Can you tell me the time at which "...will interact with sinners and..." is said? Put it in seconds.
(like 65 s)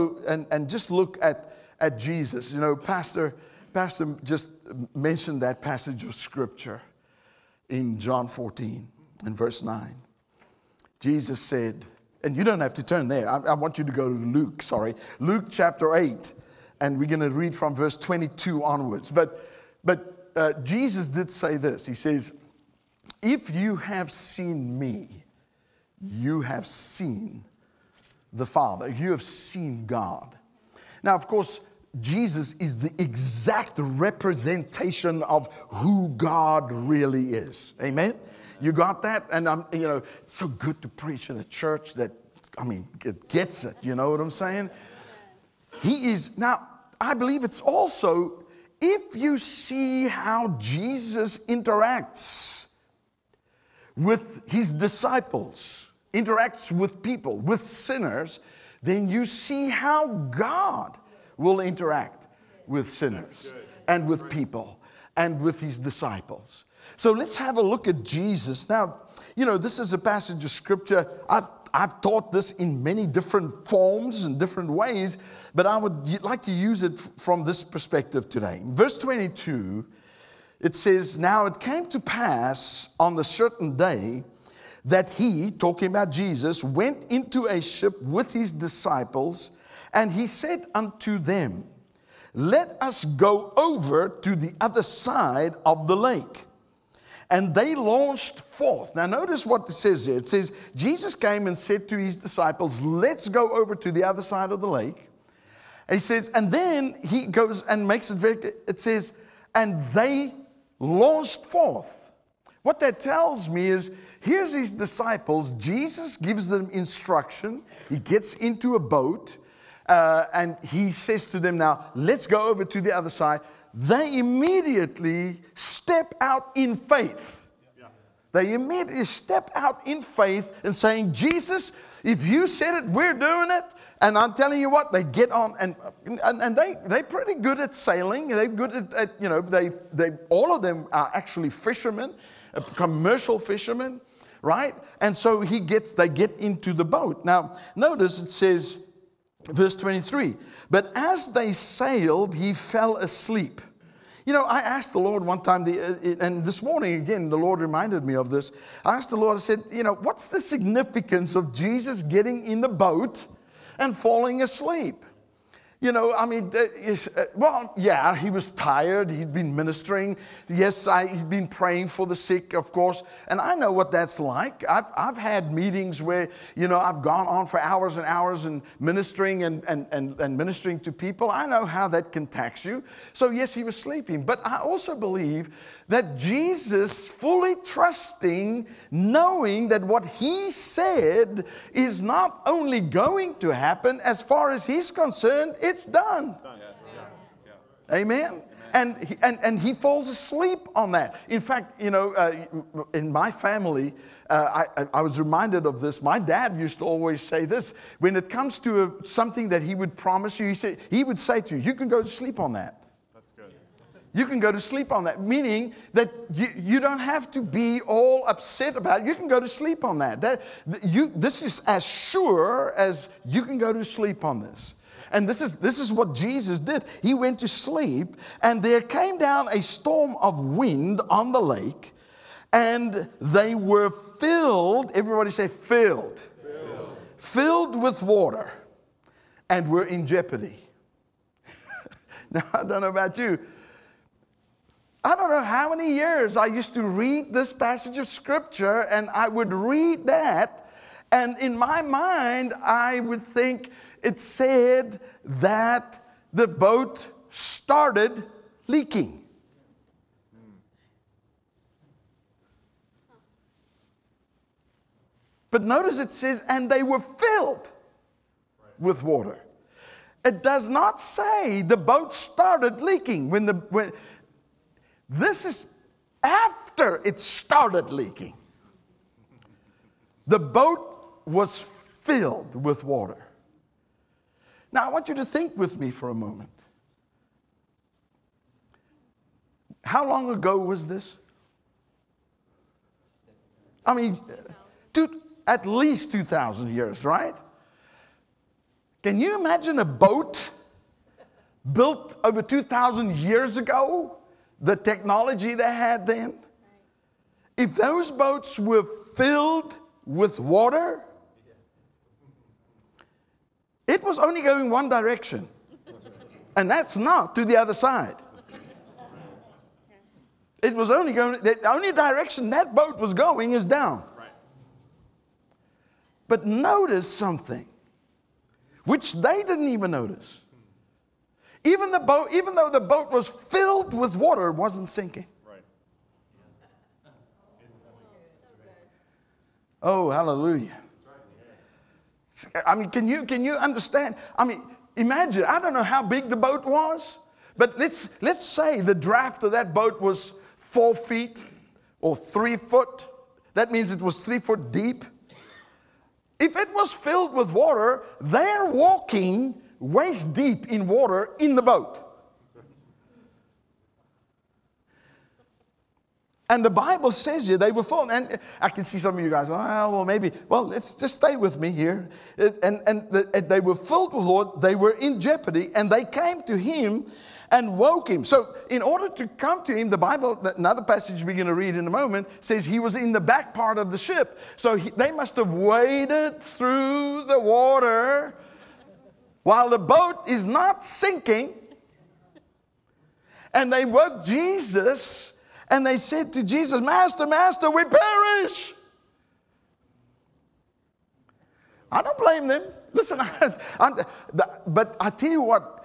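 61 s.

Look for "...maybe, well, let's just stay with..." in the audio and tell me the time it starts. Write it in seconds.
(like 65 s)
370 s.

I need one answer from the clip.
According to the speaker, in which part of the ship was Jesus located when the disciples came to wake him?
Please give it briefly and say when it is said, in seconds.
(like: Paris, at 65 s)
the back part, at 383 s.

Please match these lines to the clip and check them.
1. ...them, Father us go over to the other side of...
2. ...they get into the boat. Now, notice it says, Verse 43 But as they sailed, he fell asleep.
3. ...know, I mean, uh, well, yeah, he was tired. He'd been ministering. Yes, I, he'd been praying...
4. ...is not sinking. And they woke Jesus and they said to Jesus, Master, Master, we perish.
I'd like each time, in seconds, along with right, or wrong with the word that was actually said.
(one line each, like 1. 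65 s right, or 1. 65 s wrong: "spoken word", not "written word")
1. 91 s wrong: "Let", not "Father"
2. 145 s wrong: "23", not "43"
3. 165 s right
4. 390 s right.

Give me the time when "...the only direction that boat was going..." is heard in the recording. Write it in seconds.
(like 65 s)
321 s.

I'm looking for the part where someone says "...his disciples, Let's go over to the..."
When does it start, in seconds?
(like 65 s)
101 s.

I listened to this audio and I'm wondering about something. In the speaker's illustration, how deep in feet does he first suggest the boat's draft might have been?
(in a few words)
4 feet.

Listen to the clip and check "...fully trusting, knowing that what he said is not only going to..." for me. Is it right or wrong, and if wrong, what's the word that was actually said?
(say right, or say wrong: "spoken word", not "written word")
right.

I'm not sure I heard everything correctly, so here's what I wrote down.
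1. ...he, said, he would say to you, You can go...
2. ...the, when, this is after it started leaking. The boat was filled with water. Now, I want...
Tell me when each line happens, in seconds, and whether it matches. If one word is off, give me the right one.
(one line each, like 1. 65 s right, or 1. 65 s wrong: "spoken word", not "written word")
1. 210 s right
2. 273 s right.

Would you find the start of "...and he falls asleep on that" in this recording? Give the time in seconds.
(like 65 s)
199 s.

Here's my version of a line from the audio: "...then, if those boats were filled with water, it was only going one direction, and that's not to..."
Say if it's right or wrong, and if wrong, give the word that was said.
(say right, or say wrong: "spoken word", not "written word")
right.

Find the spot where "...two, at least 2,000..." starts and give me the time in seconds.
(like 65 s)
294 s.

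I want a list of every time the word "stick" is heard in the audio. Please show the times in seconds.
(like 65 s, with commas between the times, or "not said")
not said.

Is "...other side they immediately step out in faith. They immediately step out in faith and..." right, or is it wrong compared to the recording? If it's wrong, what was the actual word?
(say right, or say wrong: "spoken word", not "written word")
right.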